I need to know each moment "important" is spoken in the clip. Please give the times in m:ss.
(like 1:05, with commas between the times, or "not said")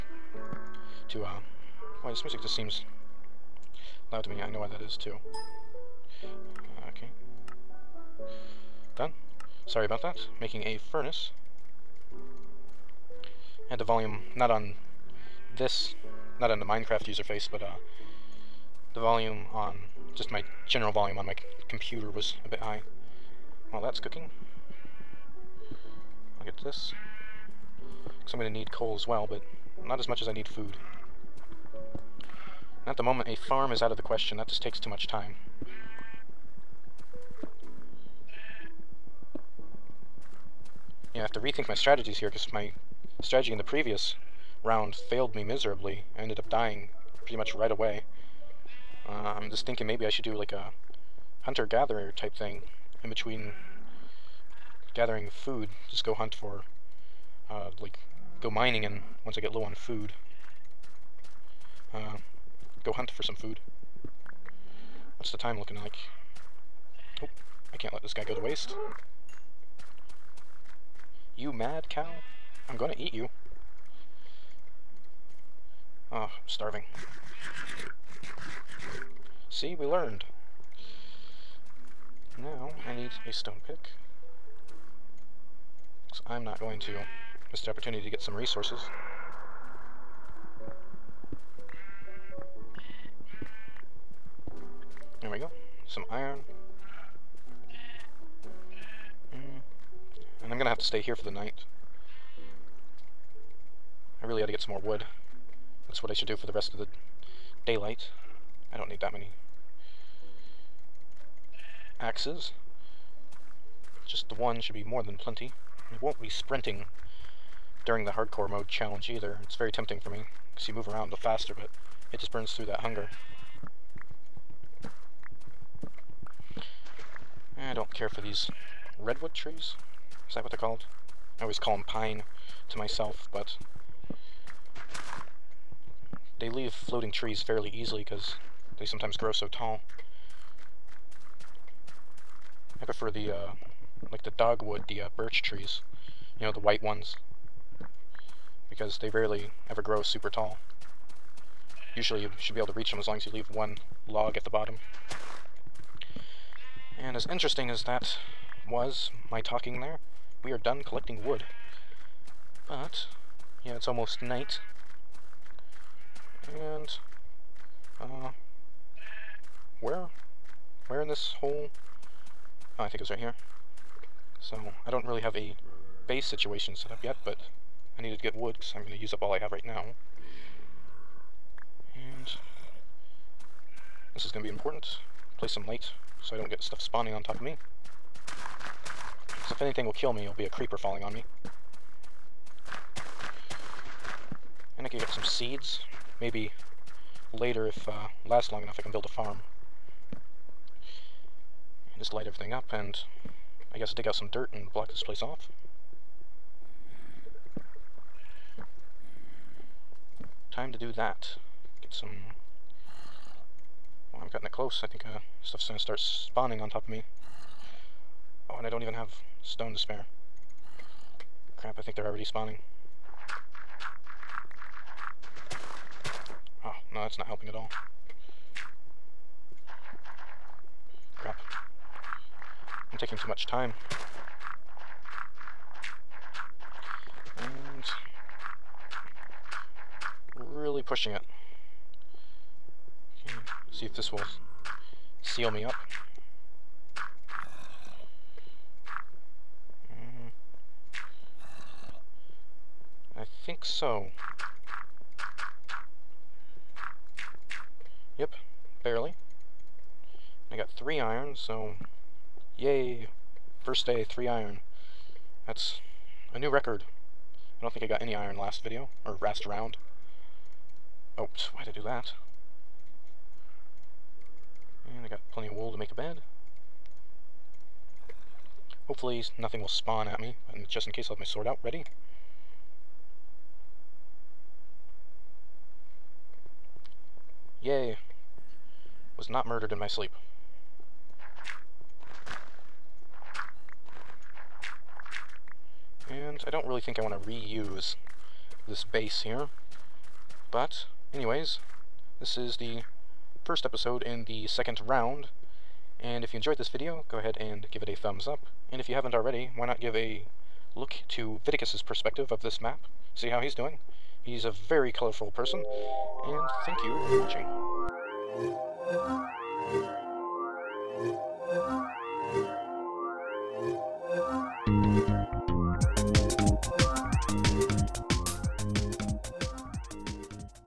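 3:04.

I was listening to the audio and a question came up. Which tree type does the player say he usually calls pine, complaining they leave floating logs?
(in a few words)
redwood.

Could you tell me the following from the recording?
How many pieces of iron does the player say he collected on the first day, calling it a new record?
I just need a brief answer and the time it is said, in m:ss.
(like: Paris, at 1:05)
3, at 4:20.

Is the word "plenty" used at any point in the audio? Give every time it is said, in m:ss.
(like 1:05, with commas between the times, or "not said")
1:55, 4:35.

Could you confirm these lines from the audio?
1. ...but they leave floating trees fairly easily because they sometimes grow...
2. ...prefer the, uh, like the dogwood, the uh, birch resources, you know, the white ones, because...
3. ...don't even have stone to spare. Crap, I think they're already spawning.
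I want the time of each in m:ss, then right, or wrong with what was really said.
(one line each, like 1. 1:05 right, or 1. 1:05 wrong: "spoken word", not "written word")
1. 2:13 right
2. 2:22 wrong: "trees", not "resources"
3. 3:38 right.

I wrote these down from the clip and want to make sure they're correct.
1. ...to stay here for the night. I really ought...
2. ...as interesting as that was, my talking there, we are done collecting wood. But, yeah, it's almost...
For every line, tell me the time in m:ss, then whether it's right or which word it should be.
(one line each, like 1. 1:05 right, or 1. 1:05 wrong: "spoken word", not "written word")
1. 1:40 right
2. 2:37 right.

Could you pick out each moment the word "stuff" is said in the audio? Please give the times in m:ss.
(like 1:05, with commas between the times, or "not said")
3:06, 3:35.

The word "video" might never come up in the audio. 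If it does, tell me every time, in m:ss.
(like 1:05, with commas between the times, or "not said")
4:28, 5:06.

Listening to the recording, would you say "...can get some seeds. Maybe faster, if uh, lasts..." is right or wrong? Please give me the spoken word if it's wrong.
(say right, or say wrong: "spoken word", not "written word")
wrong: "later", not "faster".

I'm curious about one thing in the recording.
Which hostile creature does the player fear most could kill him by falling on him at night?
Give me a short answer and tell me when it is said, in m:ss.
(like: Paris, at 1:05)
creeper, at 3:10.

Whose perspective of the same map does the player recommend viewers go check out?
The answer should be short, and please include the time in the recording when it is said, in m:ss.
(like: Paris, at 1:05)
Vidicus, at 5:11.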